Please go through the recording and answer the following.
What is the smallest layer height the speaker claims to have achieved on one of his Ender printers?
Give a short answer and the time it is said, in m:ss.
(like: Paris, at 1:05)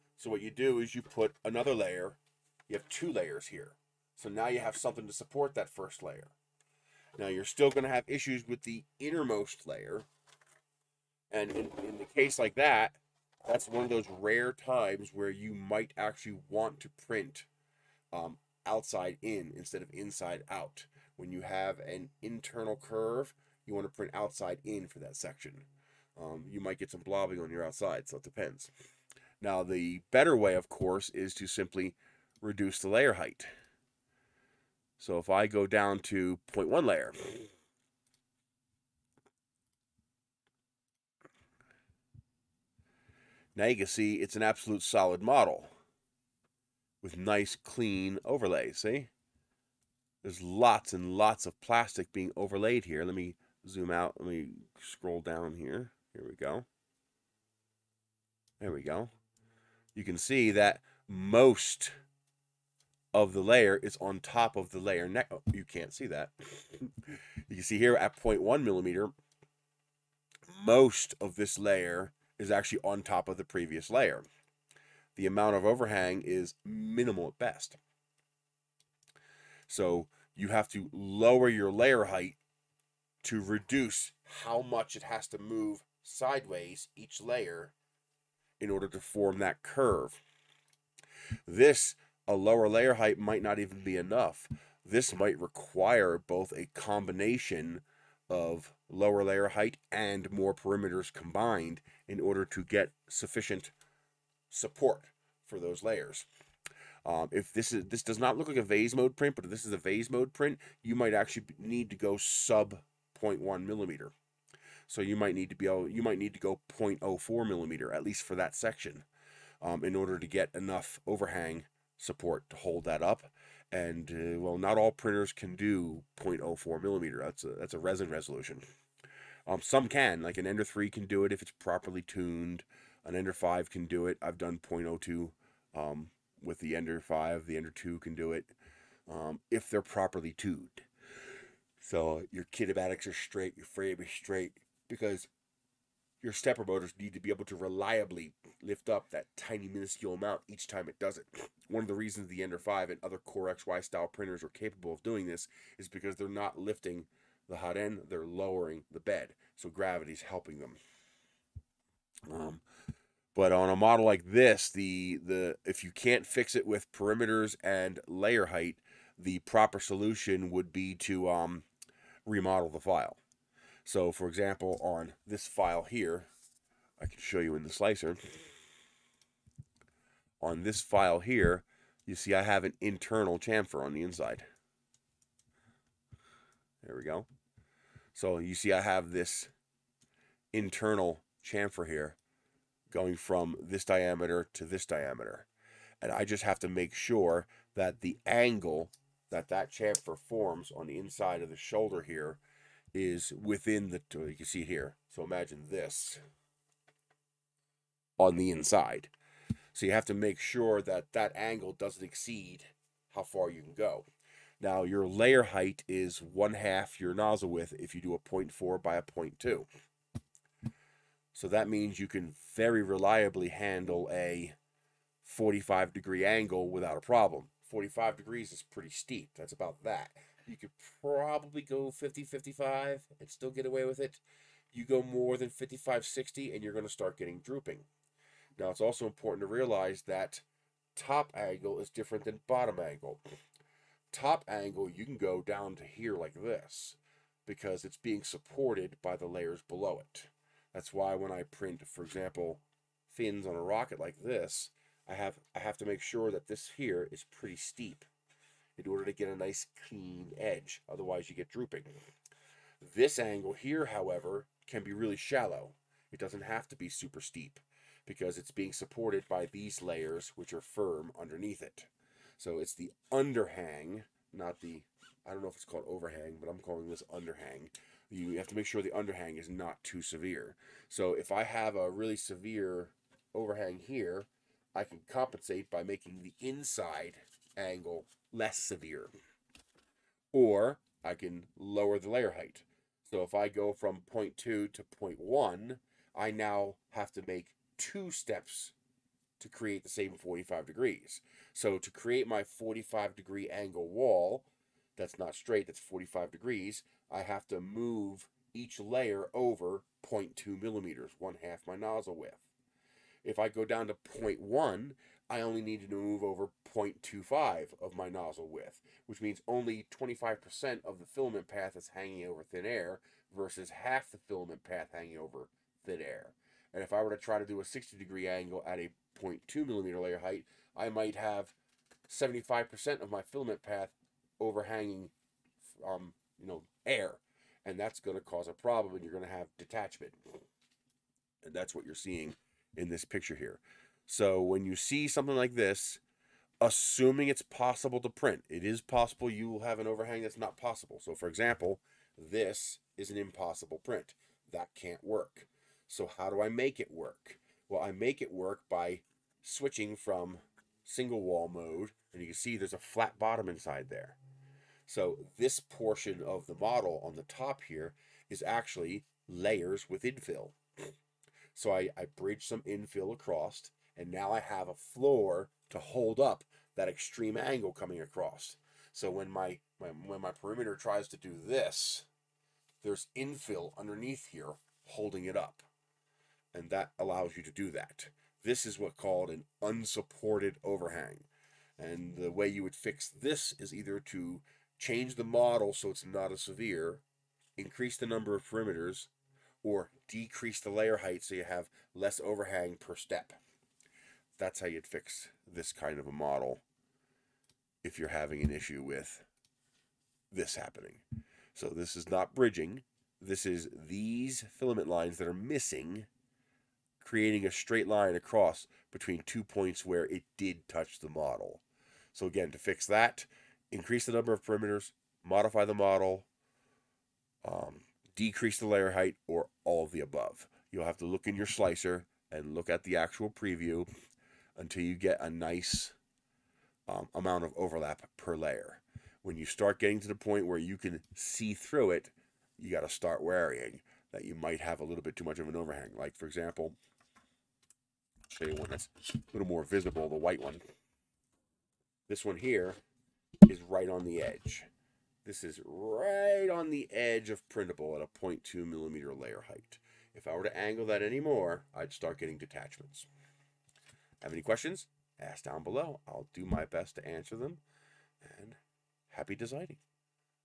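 0.02, at 2:14.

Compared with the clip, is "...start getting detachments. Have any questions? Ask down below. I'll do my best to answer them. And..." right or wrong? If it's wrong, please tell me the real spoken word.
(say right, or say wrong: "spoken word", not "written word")
right.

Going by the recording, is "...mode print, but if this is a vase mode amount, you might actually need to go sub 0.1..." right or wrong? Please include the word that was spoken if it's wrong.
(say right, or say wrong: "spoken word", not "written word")
wrong: "print", not "amount".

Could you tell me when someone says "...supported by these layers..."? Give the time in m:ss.
4:28.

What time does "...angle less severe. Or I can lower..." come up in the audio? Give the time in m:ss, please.
4:47.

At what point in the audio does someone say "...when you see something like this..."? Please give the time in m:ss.
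5:44.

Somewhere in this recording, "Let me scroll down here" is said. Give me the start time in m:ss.
0:54.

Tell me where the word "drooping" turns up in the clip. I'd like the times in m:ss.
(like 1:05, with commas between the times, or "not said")
3:57, 4:21.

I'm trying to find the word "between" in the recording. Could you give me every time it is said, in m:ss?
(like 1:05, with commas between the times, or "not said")
6:58.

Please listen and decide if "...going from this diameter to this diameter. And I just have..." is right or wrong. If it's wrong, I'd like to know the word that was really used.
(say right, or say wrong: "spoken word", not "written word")
right.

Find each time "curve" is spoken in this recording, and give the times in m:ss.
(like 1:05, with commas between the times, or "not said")
0:22, 1:29.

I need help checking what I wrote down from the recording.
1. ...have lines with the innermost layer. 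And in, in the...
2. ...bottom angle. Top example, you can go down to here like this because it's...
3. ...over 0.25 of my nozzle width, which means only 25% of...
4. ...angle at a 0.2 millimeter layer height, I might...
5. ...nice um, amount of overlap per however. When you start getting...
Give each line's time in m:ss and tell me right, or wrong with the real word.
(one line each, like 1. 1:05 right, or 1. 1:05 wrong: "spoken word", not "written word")
1. 0:07 wrong: "issues", not "lines"
2. 4:02 wrong: "angle", not "example"
3. 5:16 right
4. 5:28 right
5. 7:15 wrong: "layer", not "however".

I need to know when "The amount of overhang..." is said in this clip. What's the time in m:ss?
1:15.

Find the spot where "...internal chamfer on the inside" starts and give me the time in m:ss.
3:02.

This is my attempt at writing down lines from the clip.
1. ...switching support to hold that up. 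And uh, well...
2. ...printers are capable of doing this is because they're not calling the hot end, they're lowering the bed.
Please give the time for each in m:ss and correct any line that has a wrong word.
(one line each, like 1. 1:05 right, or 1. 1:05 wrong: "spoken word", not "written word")
1. 2:01 wrong: "overhang", not "switching"
2. 2:34 wrong: "lifting", not "calling".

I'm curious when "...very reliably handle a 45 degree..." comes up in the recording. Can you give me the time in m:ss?
3:42.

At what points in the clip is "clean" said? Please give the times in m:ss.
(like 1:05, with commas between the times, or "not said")
0:47, 4:19.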